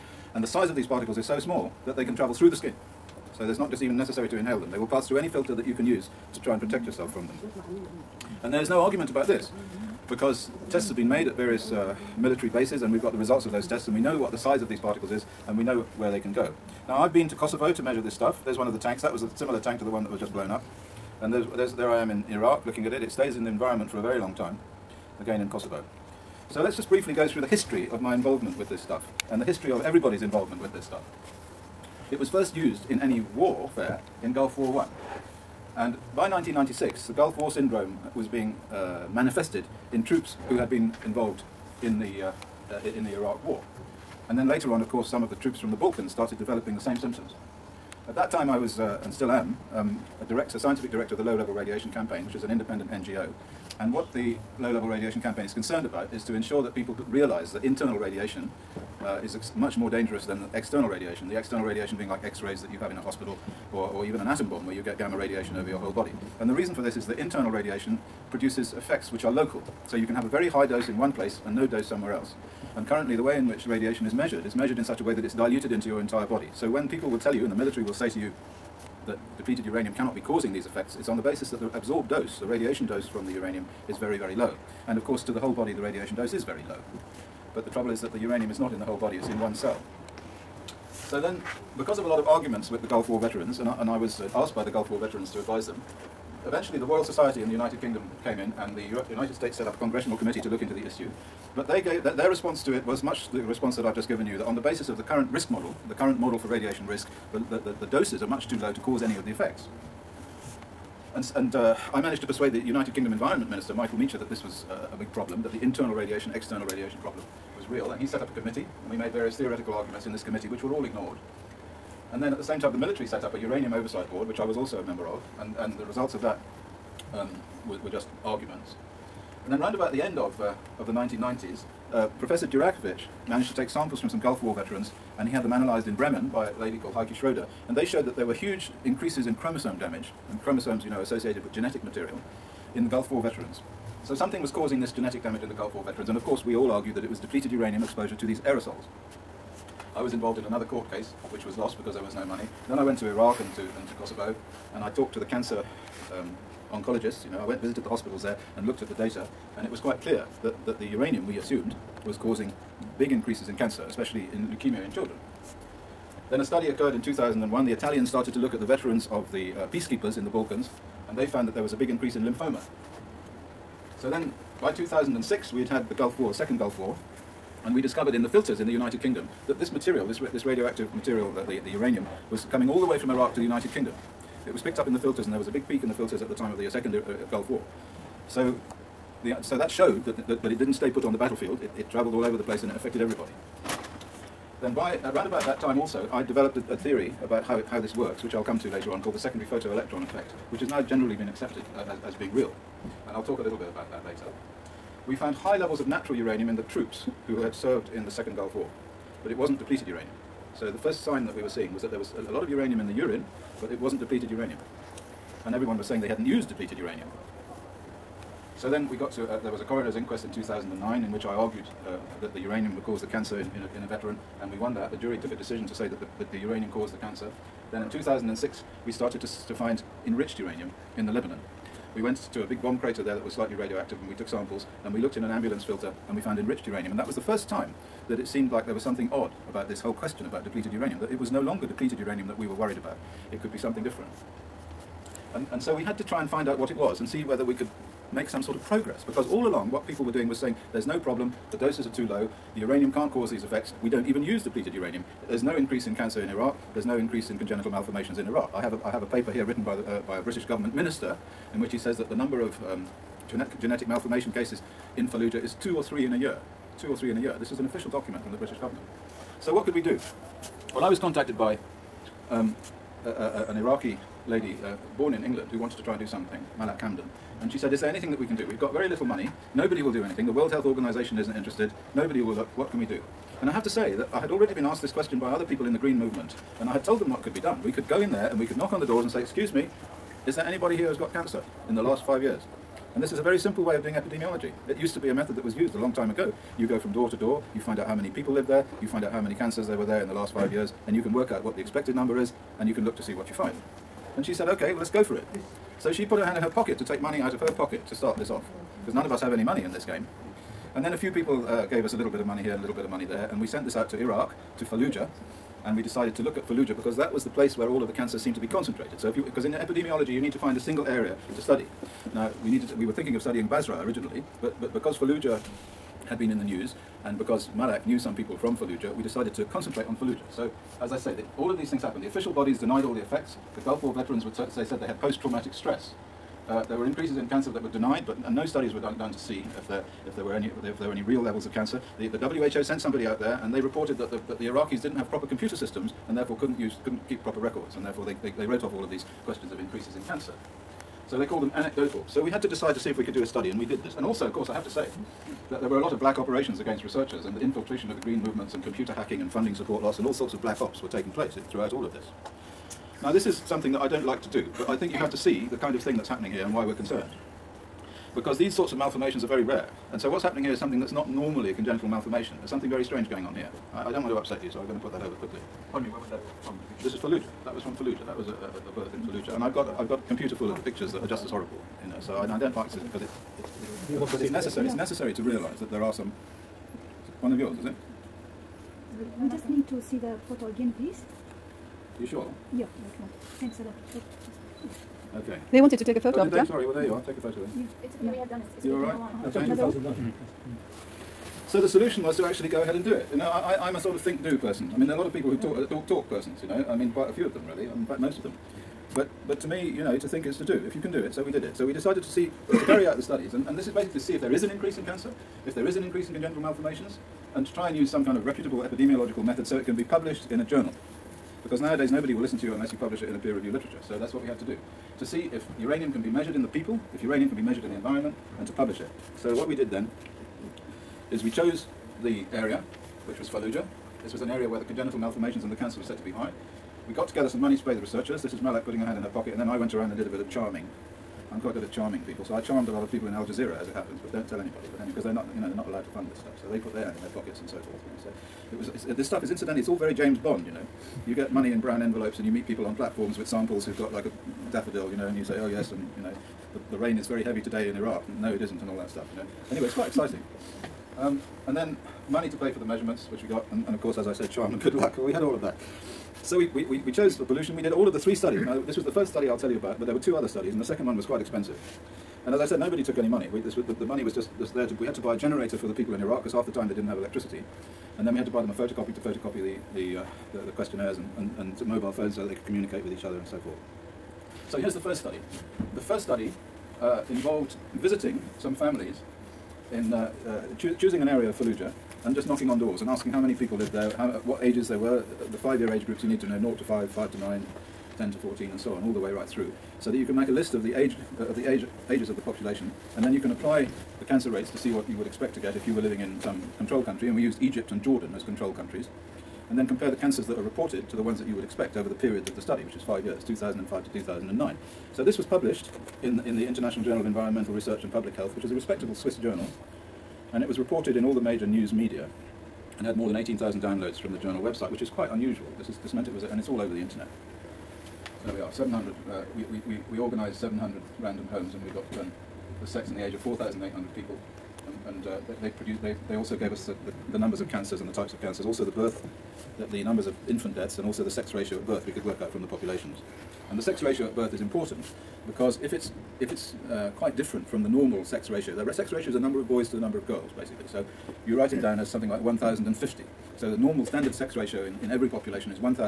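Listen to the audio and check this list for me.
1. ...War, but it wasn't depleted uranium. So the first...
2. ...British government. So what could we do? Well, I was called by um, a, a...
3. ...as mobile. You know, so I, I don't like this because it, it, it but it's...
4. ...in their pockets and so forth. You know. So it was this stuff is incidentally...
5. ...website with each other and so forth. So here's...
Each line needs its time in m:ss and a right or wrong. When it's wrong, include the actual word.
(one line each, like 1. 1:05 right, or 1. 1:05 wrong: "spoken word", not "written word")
1. 3:28 right
2. 4:28 wrong: "contacted", not "called"
3. 6:21 wrong: "horrible", not "mobile"
4. 7:26 right
5. 8:02 wrong: "communicate", not "website".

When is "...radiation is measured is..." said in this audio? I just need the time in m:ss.
1:13.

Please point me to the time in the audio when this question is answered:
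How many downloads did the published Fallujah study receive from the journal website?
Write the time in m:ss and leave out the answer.
8:42.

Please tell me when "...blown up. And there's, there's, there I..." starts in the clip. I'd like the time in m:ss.
0:20.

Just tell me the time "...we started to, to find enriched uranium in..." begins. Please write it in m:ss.
3:48.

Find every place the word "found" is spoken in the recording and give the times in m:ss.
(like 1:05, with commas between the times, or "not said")
2:51, 3:25, 3:56.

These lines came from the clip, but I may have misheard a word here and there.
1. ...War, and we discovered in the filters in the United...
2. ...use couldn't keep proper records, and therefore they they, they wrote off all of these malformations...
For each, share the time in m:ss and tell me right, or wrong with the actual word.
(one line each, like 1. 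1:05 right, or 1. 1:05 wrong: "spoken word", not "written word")
1. 2:56 right
2. 5:46 wrong: "questions", not "malformations".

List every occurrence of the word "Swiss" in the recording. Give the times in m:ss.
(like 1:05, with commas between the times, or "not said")
8:38.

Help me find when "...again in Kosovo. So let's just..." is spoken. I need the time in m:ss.
0:25.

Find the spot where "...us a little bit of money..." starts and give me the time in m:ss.
5:11.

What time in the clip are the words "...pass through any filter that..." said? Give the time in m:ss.
0:04.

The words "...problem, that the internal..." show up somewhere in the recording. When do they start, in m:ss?
1:55.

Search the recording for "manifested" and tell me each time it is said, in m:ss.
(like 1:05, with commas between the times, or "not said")
0:39.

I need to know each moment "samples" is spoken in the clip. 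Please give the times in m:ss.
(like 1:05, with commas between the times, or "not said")
2:13, 3:54, 7:33.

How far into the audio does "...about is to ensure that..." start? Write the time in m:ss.
0:55.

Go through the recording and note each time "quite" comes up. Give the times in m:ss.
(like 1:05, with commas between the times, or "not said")
2:39, 6:46, 7:21, 7:39, 7:51, 8:44, 9:06.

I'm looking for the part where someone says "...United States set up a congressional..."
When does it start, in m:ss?
1:39.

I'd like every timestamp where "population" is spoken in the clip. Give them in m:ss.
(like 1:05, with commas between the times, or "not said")
8:22, 9:02, 9:15.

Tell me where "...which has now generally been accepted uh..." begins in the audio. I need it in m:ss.
3:20.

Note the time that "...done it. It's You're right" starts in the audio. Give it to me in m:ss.
6:38.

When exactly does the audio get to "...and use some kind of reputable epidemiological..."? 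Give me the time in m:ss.
6:57.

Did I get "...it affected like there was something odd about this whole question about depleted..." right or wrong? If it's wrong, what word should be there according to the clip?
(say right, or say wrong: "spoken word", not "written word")
wrong: "seemed", not "affected".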